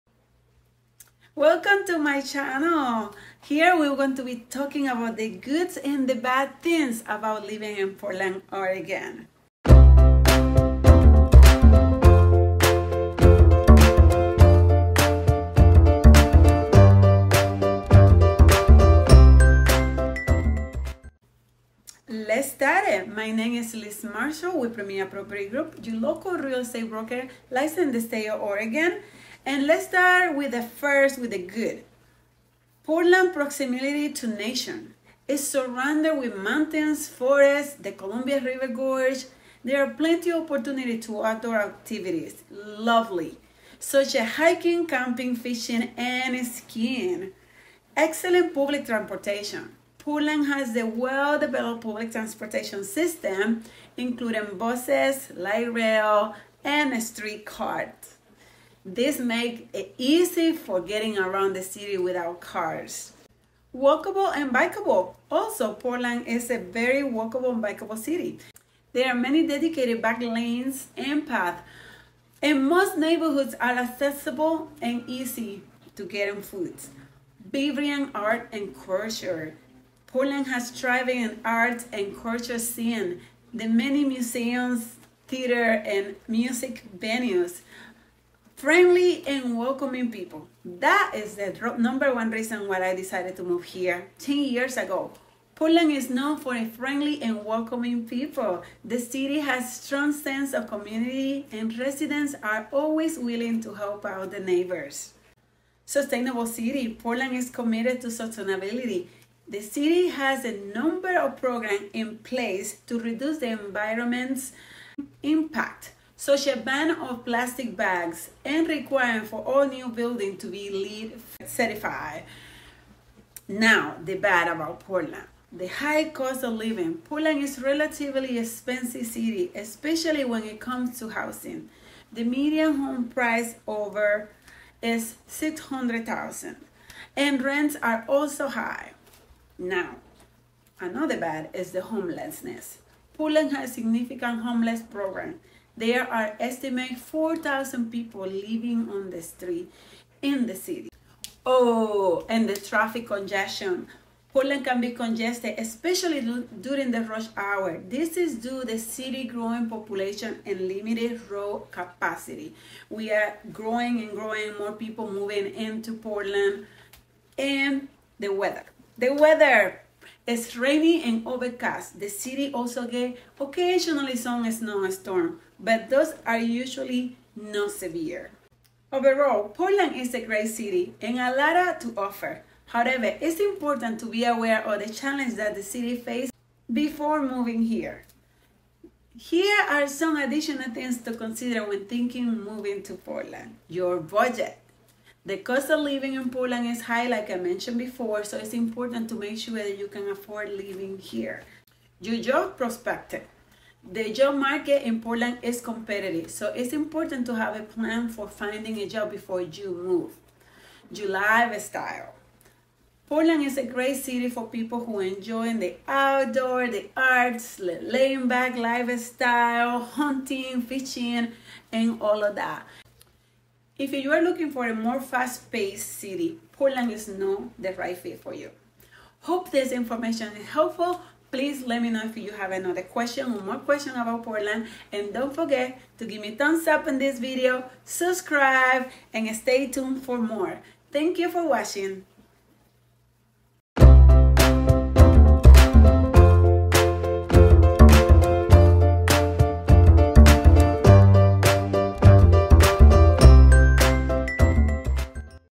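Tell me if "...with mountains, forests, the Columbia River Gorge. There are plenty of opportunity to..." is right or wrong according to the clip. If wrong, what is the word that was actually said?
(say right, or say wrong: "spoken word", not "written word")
right.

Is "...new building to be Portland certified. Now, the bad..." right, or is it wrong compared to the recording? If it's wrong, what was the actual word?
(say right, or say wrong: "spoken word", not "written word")
wrong: "LEED", not "Portland".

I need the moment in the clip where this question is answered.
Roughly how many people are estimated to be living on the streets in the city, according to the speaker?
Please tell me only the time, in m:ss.
2:26.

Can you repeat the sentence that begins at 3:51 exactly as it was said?
Please let me know if you have another question or more question about Portland.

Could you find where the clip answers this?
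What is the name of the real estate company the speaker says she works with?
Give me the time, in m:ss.
0:24.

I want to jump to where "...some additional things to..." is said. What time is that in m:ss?
3:09.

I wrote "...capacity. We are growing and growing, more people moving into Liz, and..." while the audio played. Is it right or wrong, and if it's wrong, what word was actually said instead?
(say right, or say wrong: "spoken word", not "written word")
wrong: "Portland", not "Liz".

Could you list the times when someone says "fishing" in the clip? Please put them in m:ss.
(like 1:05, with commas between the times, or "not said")
0:45, 3:40.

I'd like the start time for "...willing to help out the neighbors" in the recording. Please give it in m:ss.
1:43.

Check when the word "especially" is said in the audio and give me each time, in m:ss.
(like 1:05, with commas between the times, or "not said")
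2:09, 2:35.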